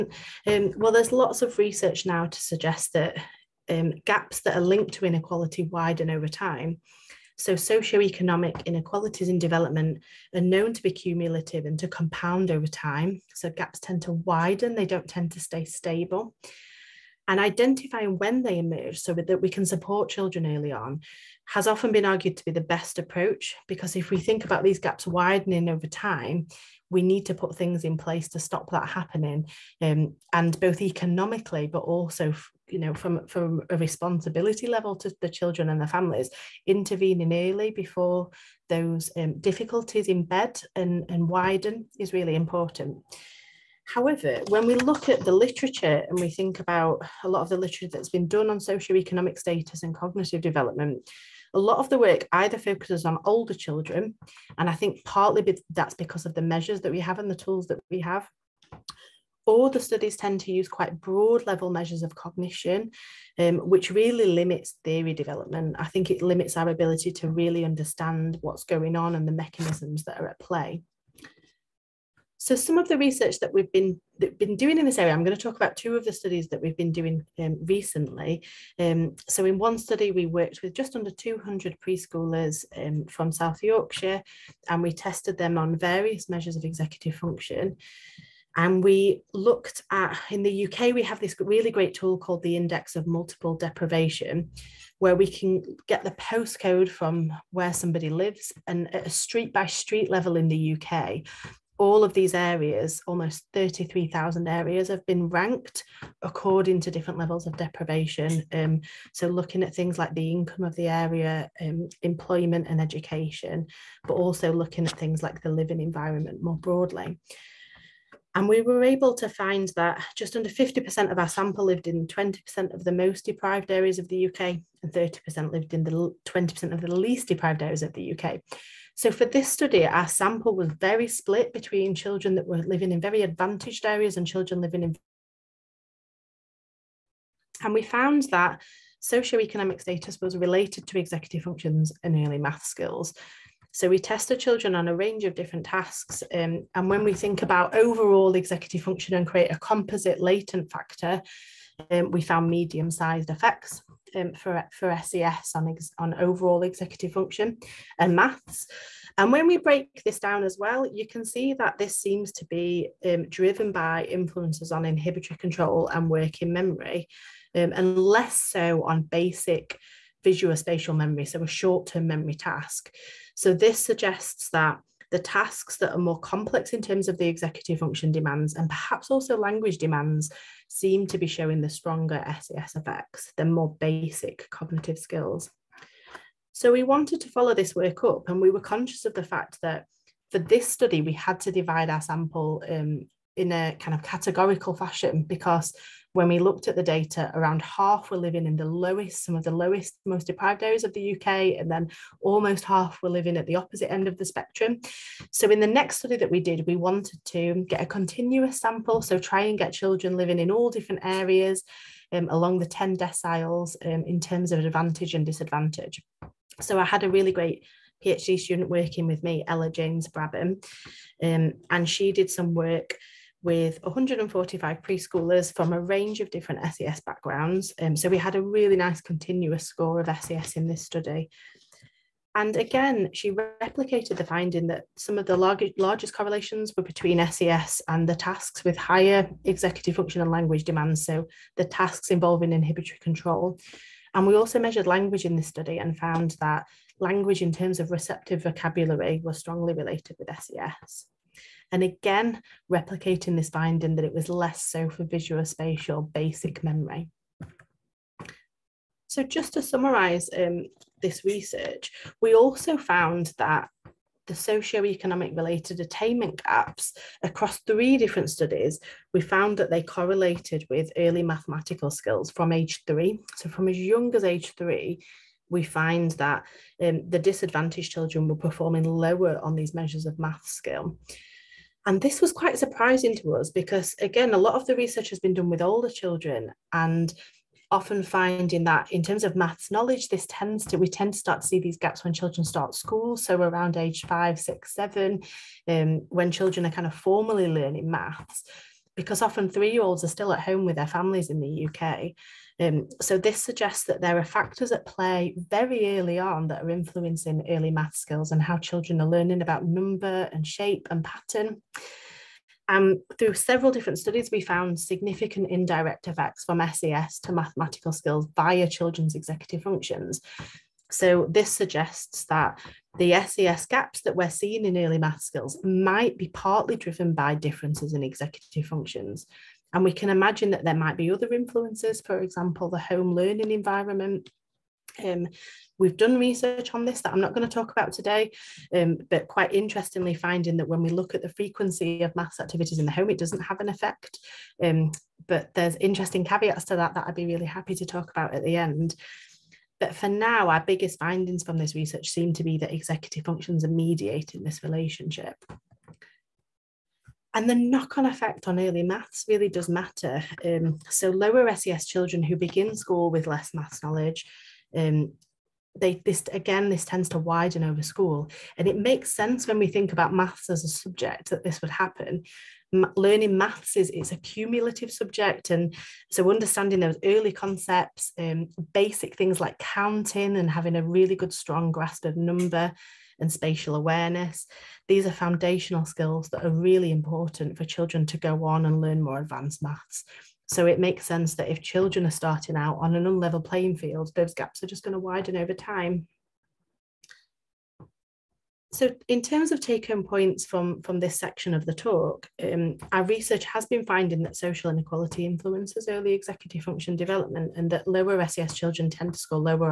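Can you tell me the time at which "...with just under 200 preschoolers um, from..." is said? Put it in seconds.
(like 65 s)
80 s.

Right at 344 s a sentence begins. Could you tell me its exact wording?
Um, but there's interesting caveats to that that I'd be really happy to talk about at the end.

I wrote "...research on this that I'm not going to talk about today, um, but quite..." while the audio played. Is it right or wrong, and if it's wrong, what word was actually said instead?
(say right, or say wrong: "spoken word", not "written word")
right.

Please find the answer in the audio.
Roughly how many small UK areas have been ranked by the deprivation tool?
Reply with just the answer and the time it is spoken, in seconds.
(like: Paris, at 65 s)
33,000, at 103 s.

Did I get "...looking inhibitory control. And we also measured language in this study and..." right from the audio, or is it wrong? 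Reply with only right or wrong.
wrong.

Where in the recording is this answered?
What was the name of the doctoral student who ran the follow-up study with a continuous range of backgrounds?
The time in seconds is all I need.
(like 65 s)
219 s.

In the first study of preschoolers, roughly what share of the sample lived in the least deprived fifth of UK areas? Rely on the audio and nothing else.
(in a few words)
30%.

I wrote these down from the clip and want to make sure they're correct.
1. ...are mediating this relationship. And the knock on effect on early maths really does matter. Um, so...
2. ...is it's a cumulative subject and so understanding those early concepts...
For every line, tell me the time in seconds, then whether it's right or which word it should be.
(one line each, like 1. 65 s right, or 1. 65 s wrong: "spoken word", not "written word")
1. 353 s right
2. 373 s right.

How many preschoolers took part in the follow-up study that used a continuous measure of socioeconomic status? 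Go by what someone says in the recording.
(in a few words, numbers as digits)
145.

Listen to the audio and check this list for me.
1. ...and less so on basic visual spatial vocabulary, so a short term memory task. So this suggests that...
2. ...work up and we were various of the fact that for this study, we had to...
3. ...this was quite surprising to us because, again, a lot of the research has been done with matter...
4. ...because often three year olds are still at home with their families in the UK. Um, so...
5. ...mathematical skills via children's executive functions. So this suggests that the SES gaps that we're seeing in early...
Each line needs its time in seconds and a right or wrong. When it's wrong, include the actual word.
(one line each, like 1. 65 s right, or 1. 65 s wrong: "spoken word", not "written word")
1. 167 s wrong: "memory", not "vocabulary"
2. 187 s wrong: "conscious", not "various"
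3. 282 s wrong: "older", not "matter"
4. 298 s right
5. 317 s right.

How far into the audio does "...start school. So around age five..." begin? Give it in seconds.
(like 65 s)
292 s.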